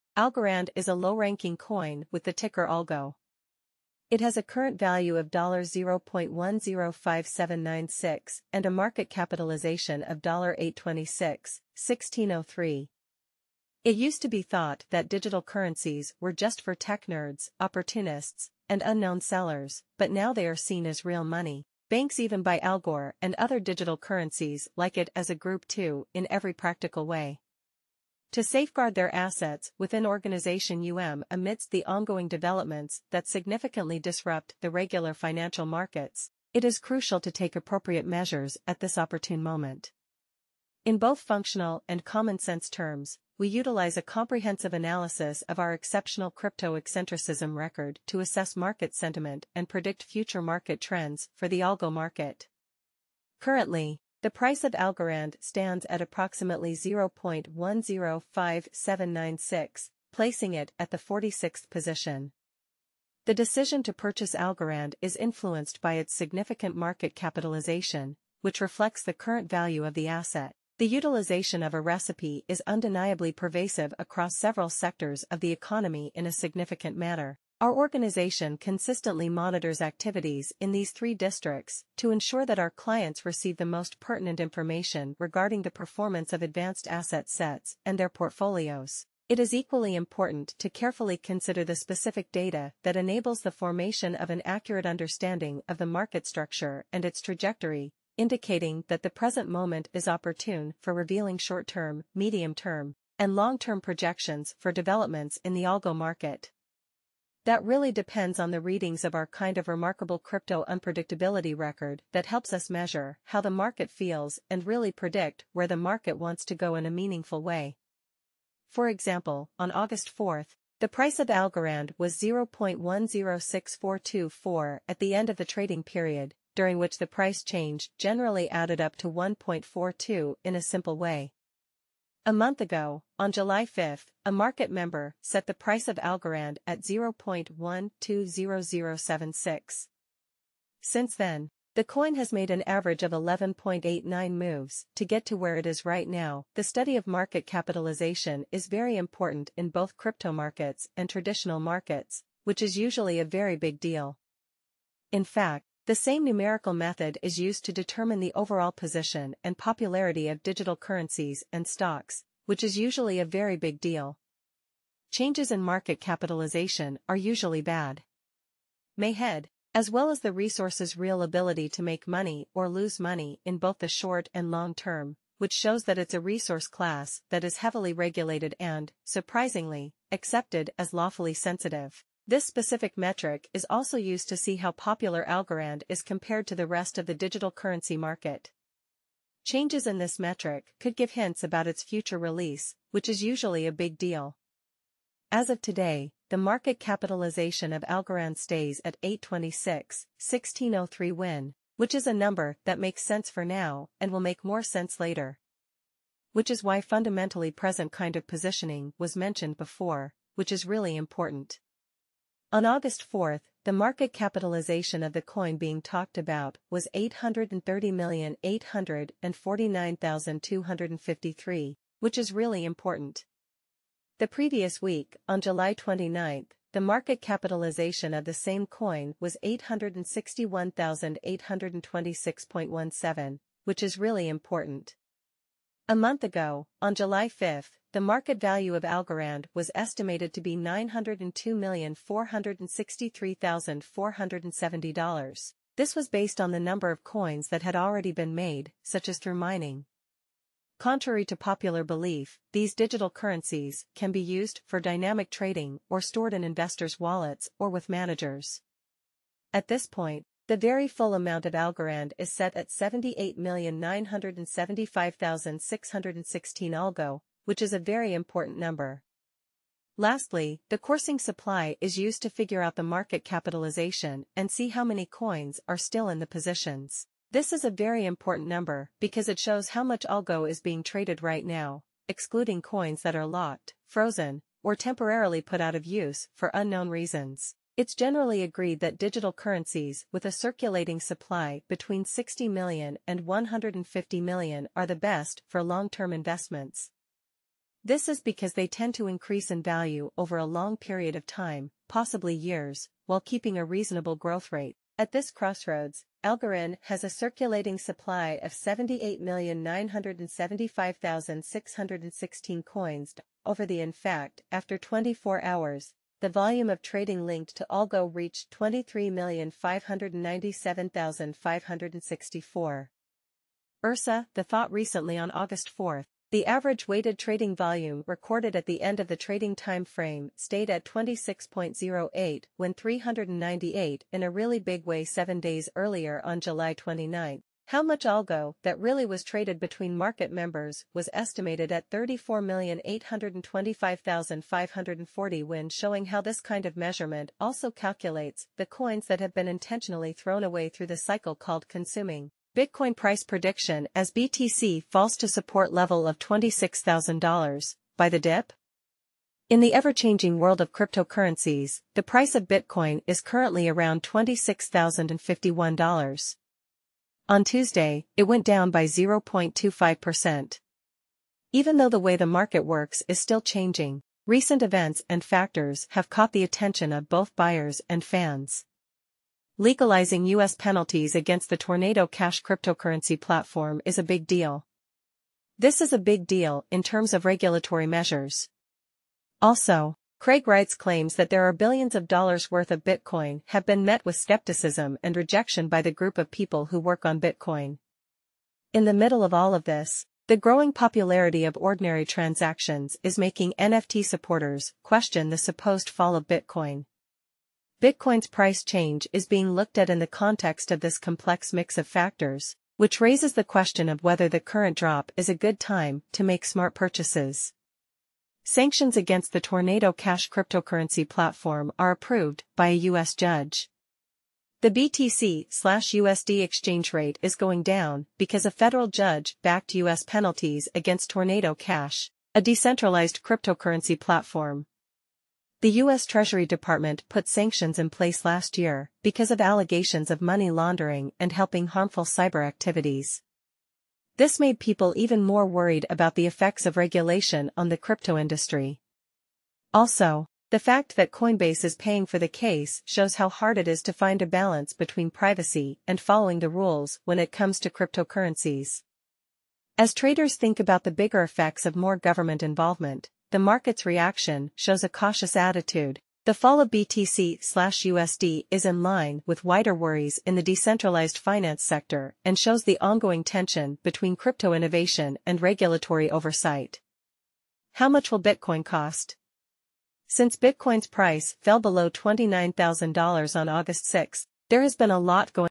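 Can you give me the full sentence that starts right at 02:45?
Changes in market capitalization are usually bad.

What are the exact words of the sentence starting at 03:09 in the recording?
Changes in this metric could give hints about its future release, which is usually a big deal.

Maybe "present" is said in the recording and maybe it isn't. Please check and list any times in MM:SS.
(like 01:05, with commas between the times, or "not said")
01:39, 03:27.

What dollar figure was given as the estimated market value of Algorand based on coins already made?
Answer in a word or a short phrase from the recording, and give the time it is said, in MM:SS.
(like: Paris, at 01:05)
$902,463,470, at 04:00.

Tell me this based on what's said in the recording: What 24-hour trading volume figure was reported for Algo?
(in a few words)
23,597,564.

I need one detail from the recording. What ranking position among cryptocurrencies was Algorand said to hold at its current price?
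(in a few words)
46th.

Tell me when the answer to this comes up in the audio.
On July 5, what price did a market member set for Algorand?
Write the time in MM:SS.
02:16.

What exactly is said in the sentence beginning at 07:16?
Treasury Department put sanctions in place last year because of allegations of money laundering and helping harmful cyber activities.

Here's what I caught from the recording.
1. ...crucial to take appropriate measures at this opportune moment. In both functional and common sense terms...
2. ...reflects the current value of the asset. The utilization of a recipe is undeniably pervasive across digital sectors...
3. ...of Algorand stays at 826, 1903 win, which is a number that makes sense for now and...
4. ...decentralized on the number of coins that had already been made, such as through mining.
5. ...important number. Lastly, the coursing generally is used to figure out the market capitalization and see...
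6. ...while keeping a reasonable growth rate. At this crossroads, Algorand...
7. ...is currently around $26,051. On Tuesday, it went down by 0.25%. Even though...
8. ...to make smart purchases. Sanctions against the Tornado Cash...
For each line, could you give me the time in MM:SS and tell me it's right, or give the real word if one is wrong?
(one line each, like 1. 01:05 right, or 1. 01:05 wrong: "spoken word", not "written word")
1. 00:36 right
2. 01:08 wrong: "several", not "digital"
3. 03:17 wrong: "1603", not "1903"
4. 04:06 wrong: "based", not "decentralized"
5. 04:28 wrong: "supply", not "generally"
6. 05:03 right
7. 06:03 right
8. 06:56 right.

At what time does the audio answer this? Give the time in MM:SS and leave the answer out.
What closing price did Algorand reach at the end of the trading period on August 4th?
02:02.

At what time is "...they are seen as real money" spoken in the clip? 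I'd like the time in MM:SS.
00:20.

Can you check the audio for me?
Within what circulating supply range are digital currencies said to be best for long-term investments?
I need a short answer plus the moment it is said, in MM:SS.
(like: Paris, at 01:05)
60 million to 150 million, at 04:51.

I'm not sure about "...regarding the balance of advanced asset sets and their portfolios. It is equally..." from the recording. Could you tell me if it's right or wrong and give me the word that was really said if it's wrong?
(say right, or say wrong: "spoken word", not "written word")
wrong: "performance", not "balance".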